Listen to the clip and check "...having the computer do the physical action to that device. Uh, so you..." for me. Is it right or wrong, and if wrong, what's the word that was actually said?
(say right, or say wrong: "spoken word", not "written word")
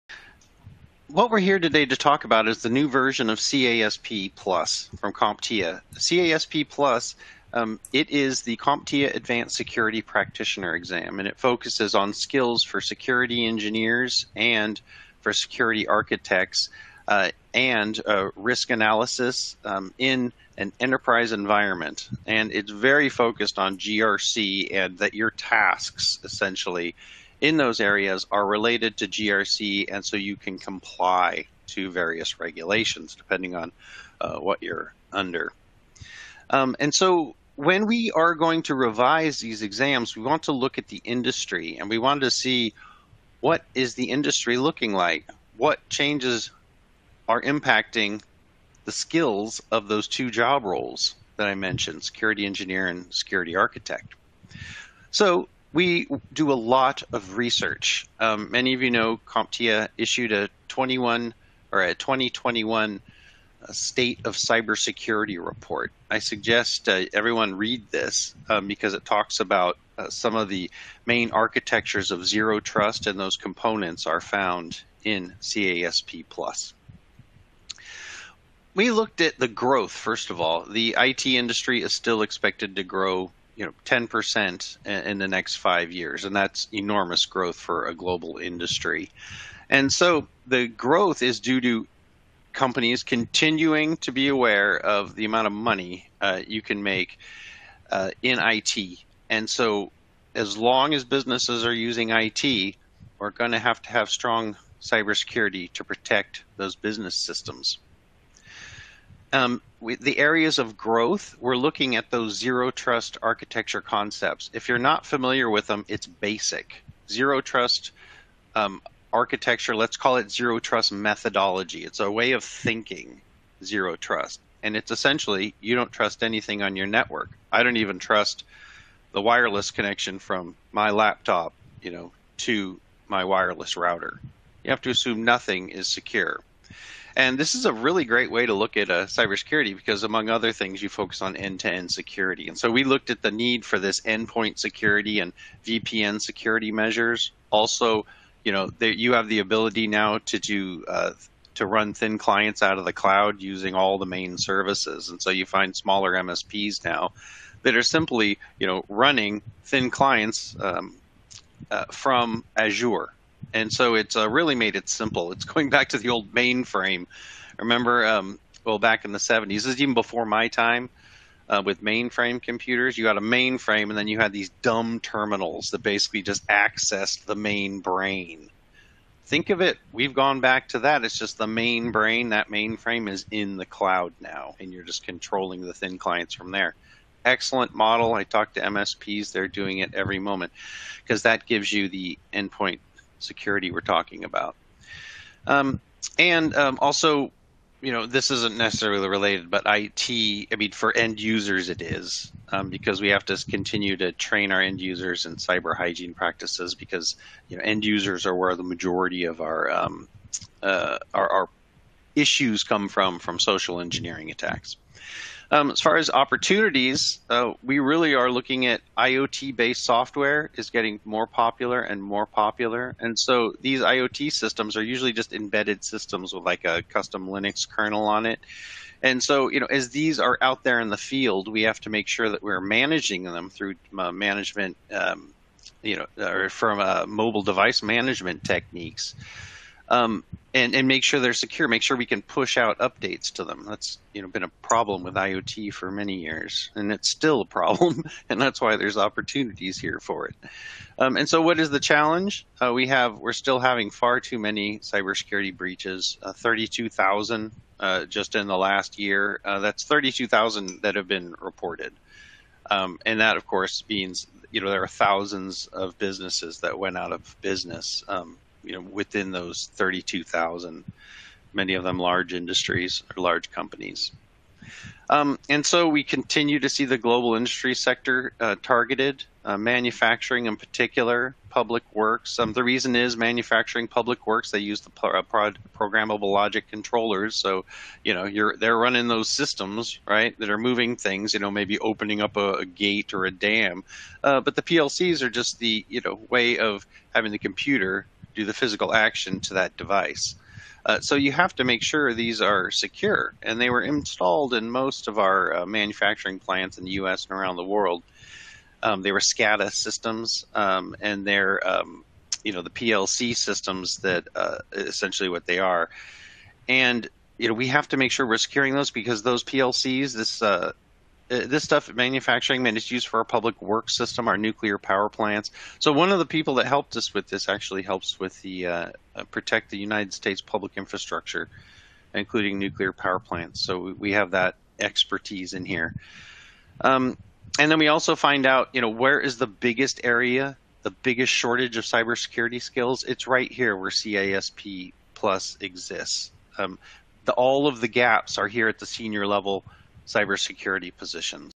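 right.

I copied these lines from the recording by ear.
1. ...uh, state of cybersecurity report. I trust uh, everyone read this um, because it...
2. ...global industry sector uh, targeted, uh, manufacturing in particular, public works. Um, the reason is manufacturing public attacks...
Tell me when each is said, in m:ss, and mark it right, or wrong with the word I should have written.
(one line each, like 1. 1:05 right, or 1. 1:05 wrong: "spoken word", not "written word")
1. 1:03 wrong: "suggest", not "trust"
2. 4:36 wrong: "works", not "attacks".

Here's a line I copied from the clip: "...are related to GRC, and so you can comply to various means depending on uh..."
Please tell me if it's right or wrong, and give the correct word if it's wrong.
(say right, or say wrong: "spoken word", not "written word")
wrong: "regulations", not "means".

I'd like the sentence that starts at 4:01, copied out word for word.
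Make sure we can push out updates to them.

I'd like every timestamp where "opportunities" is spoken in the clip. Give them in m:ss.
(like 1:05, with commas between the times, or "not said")
3:36, 4:08.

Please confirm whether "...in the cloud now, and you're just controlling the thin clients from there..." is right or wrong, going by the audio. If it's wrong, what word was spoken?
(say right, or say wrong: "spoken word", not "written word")
right.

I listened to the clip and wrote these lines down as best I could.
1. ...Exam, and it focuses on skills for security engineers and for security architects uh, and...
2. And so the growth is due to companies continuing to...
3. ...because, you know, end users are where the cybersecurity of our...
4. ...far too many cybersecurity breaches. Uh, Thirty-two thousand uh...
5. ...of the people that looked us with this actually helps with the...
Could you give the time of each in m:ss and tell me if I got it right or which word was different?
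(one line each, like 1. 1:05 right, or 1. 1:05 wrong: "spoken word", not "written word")
1. 0:10 right
2. 1:29 right
3. 3:26 wrong: "majority", not "cybersecurity"
4. 4:13 right
5. 5:26 wrong: "helped", not "looked".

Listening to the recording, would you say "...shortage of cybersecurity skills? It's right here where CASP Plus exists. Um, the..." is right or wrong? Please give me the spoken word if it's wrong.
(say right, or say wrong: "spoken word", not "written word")
right.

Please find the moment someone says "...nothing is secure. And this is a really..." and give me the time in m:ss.
2:15.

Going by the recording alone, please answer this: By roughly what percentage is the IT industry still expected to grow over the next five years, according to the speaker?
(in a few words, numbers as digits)
10%.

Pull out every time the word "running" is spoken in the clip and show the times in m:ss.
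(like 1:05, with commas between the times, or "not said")
2:38, 4:48.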